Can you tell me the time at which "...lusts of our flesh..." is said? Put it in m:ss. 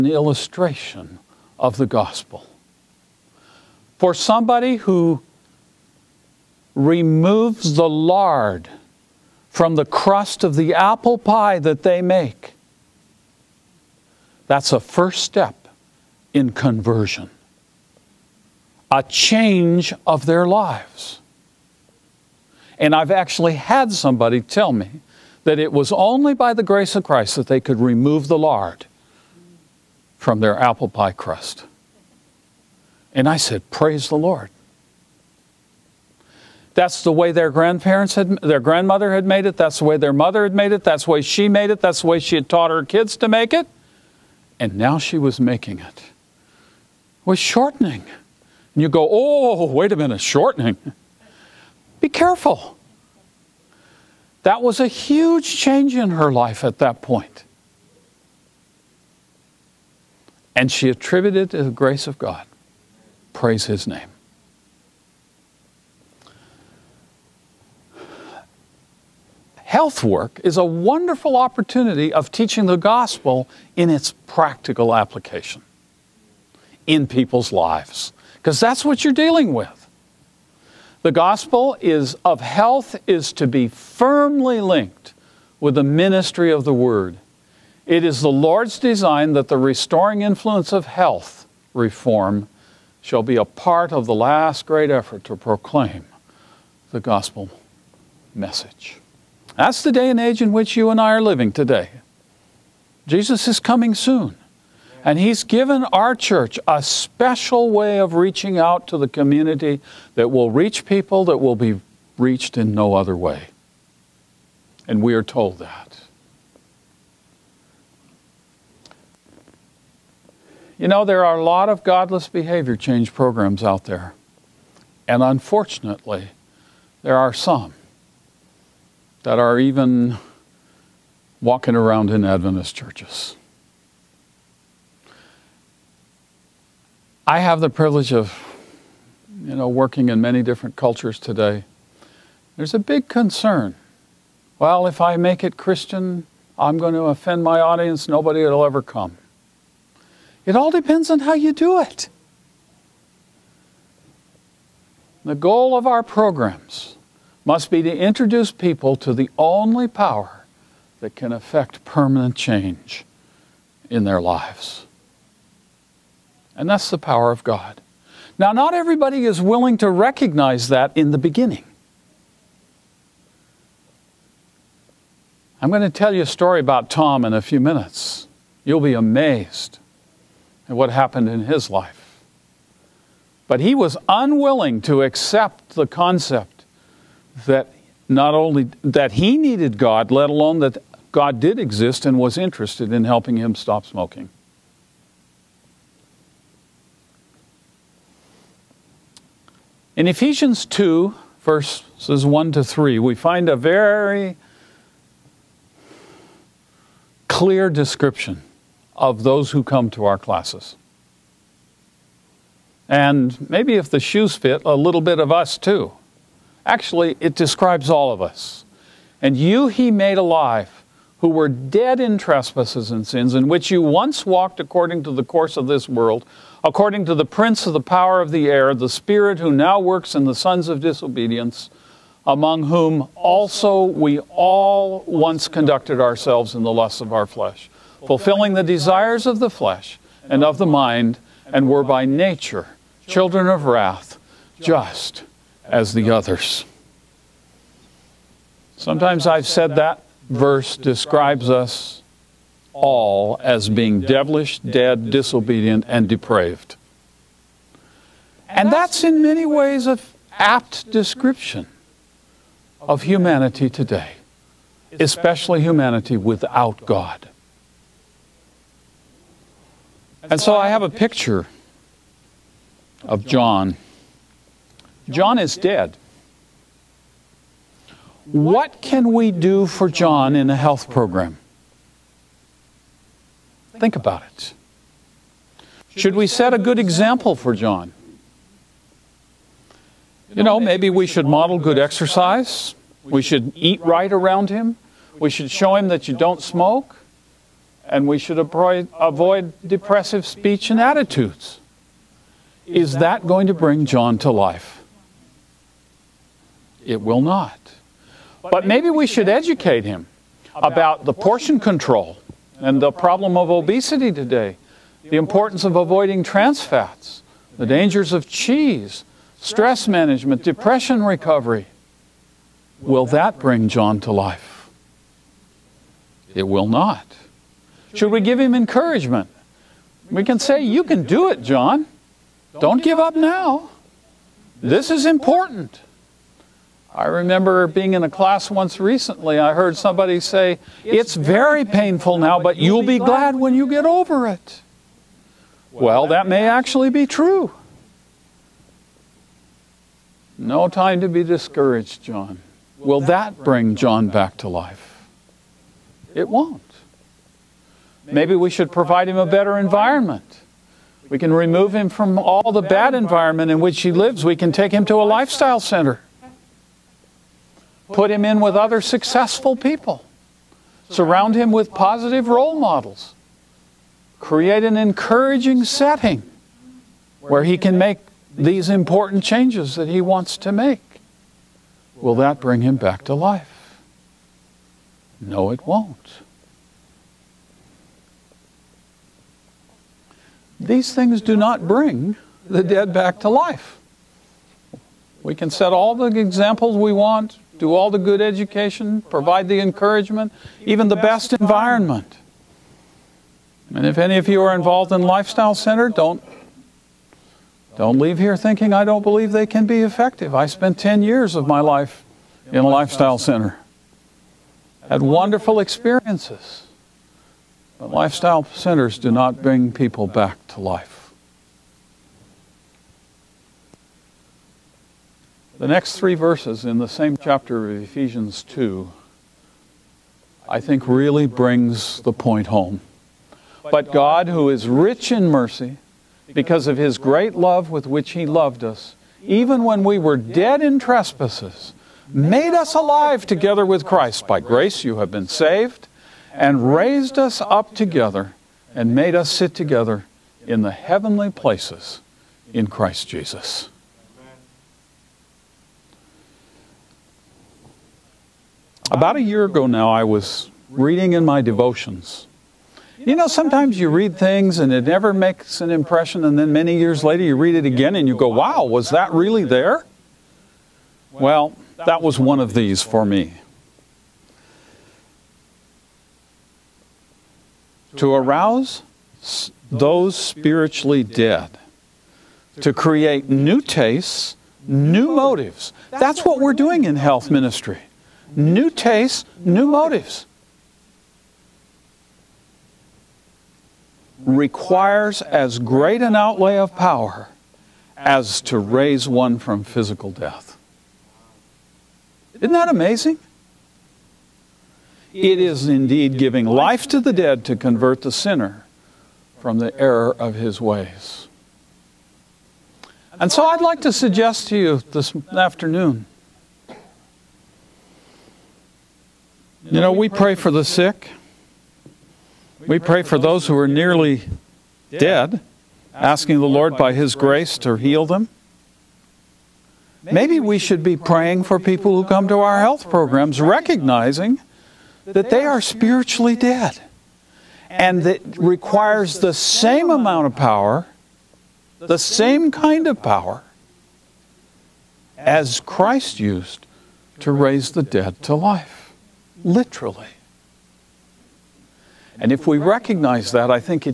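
3:56.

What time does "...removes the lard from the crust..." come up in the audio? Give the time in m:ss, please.
0:06.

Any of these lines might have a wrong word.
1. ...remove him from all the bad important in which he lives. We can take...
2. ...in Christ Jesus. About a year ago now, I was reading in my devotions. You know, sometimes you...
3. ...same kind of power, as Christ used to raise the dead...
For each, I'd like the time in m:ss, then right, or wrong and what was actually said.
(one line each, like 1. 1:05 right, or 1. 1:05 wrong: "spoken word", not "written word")
1. 6:01 wrong: "environment", not "important"
2. 7:32 right
3. 9:01 right.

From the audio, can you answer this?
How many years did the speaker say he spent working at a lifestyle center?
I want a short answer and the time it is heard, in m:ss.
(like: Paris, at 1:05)
10, at 6:50.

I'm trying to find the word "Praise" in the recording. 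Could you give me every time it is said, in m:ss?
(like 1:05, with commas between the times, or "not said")
0:33, 1:03.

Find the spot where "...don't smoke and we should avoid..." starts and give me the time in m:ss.
4:56.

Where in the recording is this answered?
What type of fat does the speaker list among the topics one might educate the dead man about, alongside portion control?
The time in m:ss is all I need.
5:16.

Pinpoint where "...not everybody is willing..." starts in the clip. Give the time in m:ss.
2:48.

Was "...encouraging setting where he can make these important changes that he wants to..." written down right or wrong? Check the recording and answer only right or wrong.
right.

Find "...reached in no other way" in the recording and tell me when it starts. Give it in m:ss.
1:52.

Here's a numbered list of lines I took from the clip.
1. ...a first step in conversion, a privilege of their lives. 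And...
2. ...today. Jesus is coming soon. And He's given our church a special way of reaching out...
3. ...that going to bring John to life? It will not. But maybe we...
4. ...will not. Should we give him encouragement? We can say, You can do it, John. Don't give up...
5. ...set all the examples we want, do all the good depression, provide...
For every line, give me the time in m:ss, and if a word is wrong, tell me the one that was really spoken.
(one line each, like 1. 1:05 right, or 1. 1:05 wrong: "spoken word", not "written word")
1. 0:14 wrong: "change", not "privilege"
2. 1:41 right
3. 5:02 right
4. 5:26 right
5. 6:35 wrong: "education", not "depression".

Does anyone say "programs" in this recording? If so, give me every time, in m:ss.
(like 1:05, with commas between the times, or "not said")
2:03, 2:36, 4:40, 8:52.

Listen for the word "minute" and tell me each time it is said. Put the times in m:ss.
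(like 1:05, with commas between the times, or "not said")
0:49, 2:57.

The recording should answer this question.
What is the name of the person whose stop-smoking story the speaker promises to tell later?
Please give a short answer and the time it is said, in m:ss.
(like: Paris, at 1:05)
Tom, at 2:56.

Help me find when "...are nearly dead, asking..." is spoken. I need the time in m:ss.
8:43.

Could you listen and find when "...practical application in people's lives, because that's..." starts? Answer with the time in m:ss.
1:14.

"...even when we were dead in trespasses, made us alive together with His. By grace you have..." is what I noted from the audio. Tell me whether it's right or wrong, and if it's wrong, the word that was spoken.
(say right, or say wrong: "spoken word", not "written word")
wrong: "Christ", not "His".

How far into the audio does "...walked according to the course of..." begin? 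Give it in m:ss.
3:44.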